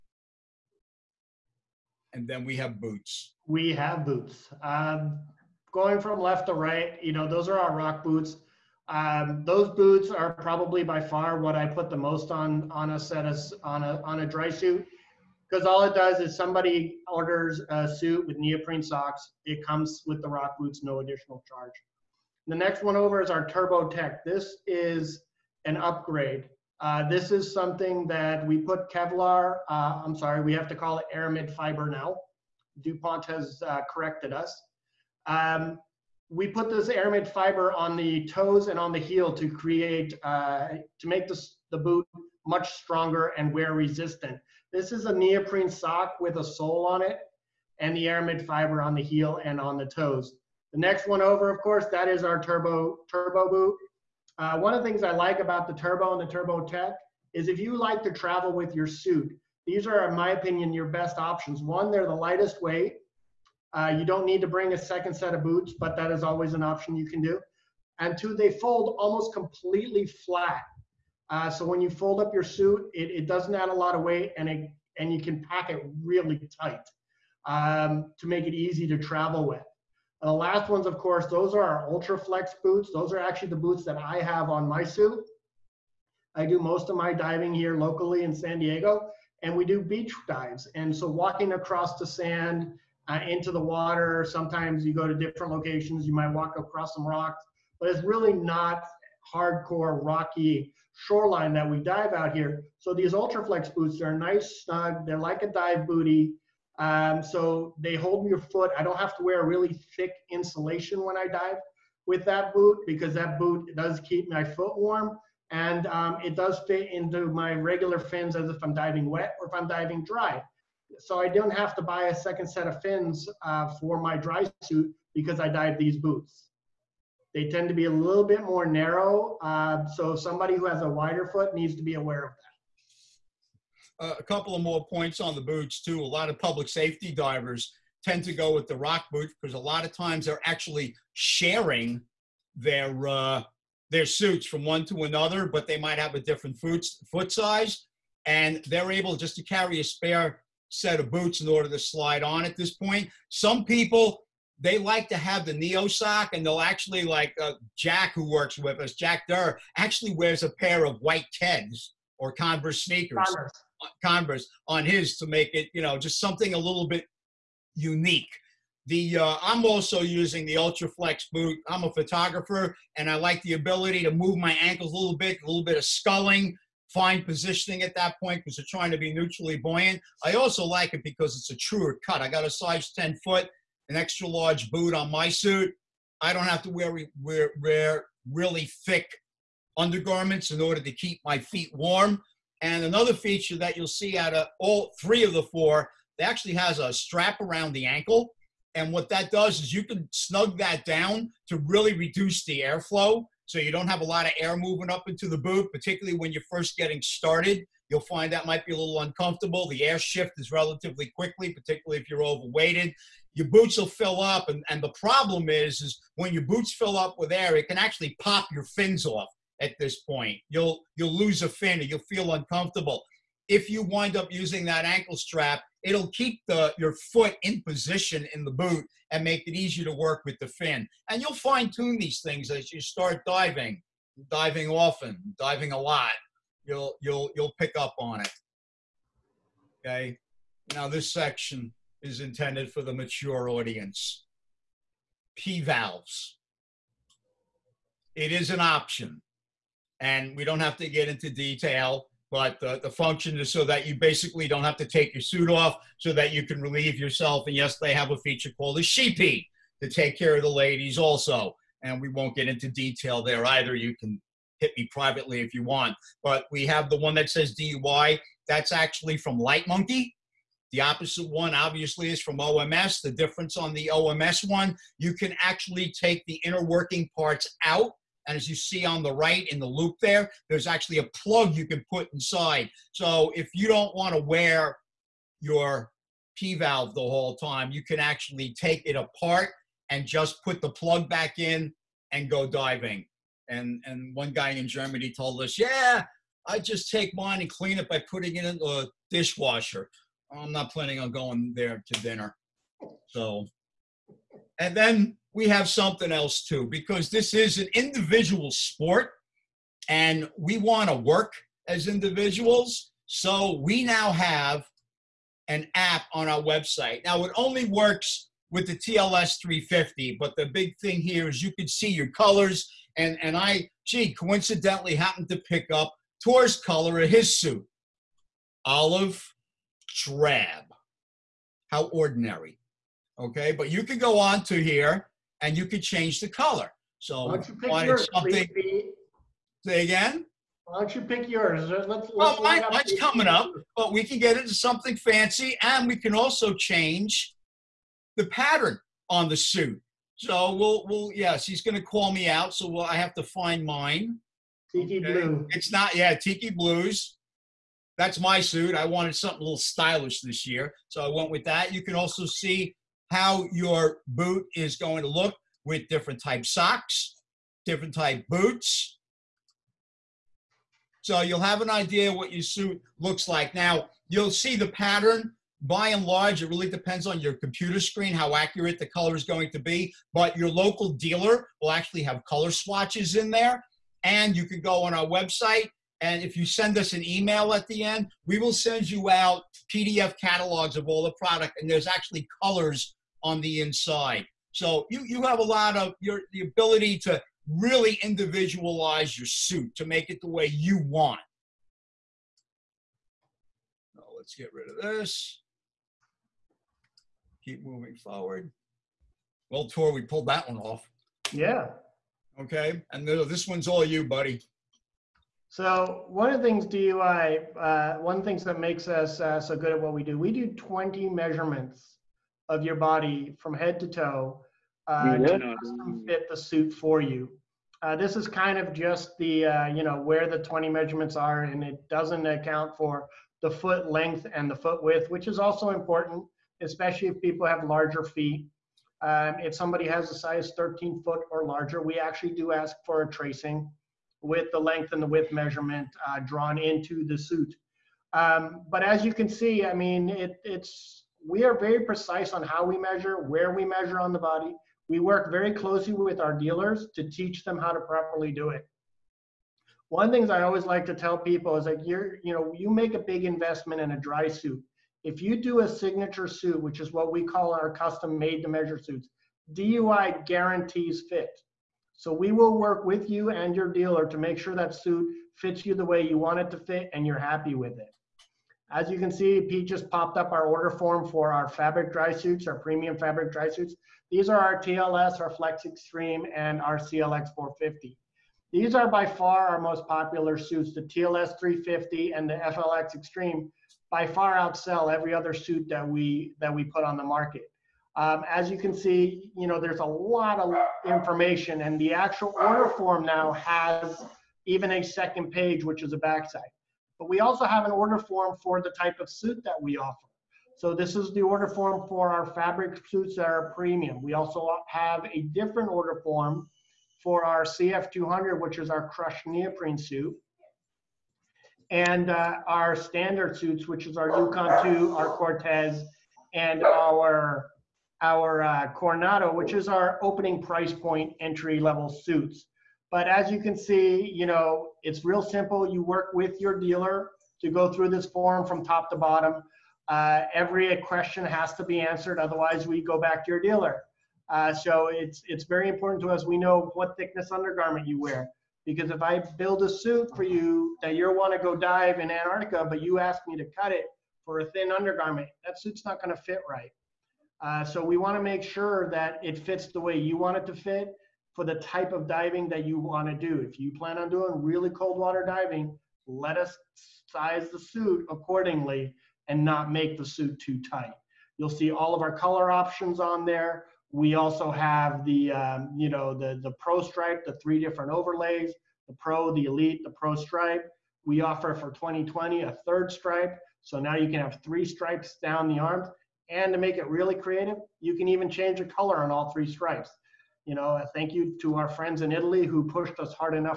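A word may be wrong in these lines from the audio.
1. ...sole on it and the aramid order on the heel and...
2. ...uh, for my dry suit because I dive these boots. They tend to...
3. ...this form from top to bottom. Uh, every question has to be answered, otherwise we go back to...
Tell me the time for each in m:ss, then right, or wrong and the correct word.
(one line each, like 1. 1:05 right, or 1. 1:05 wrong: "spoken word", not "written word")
1. 0:46 wrong: "fiber", not "order"
2. 2:03 right
3. 8:57 right.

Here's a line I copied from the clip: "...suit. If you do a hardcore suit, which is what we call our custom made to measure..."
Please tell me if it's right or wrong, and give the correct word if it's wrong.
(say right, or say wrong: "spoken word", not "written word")
wrong: "signature", not "hardcore".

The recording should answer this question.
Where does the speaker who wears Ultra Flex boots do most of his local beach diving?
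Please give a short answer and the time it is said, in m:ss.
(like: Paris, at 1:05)
San Diego, at 1:28.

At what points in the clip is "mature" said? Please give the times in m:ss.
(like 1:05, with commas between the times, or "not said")
4:02.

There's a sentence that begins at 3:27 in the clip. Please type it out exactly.
You'll find that might be a little uncomfortable.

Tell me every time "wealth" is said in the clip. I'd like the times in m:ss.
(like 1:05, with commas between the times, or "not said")
not said.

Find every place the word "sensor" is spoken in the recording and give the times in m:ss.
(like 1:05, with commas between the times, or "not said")
not said.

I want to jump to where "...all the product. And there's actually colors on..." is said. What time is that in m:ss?
6:30.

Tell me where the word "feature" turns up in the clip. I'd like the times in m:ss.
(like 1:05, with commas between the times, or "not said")
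3:13, 4:18.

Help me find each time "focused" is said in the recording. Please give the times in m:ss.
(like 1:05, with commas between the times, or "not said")
not said.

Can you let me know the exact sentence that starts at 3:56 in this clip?
You'll you'll you'll pick up on it.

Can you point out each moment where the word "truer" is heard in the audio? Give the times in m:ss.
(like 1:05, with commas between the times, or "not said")
3:01.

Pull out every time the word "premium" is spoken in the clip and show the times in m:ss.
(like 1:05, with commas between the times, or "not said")
8:02, 8:33.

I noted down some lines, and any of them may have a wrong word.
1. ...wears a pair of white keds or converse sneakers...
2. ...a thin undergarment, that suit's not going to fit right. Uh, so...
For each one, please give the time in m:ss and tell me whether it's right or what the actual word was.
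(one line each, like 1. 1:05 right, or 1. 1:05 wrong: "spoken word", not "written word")
1. 2:40 right
2. 9:14 right.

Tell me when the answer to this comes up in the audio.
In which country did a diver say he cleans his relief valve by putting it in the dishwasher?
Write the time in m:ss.
4:54.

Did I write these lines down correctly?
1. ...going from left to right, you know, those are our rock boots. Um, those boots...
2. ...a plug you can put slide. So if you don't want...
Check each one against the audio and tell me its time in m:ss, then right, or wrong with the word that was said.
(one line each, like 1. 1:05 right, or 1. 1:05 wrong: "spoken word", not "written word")
1. 0:05 right
2. 4:40 wrong: "inside", not "slide".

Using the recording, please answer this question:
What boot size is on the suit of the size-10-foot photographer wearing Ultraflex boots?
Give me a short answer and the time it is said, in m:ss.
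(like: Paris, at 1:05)
Extra large, at 3:03.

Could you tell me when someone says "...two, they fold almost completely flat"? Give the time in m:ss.
1:08.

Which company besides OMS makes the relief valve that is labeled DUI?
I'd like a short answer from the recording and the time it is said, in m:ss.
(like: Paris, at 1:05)
Light Monkey, at 4:29.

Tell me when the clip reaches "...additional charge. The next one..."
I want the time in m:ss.
0:20.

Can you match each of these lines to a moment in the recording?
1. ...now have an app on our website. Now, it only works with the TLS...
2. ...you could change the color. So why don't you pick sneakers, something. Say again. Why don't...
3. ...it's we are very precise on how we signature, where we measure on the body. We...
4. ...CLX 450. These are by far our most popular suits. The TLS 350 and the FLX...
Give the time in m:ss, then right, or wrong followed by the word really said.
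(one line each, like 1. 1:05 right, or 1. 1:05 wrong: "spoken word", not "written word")
1. 5:13 right
2. 5:35 wrong: "yours", not "sneakers"
3. 7:30 wrong: "measure", not "signature"
4. 8:06 right.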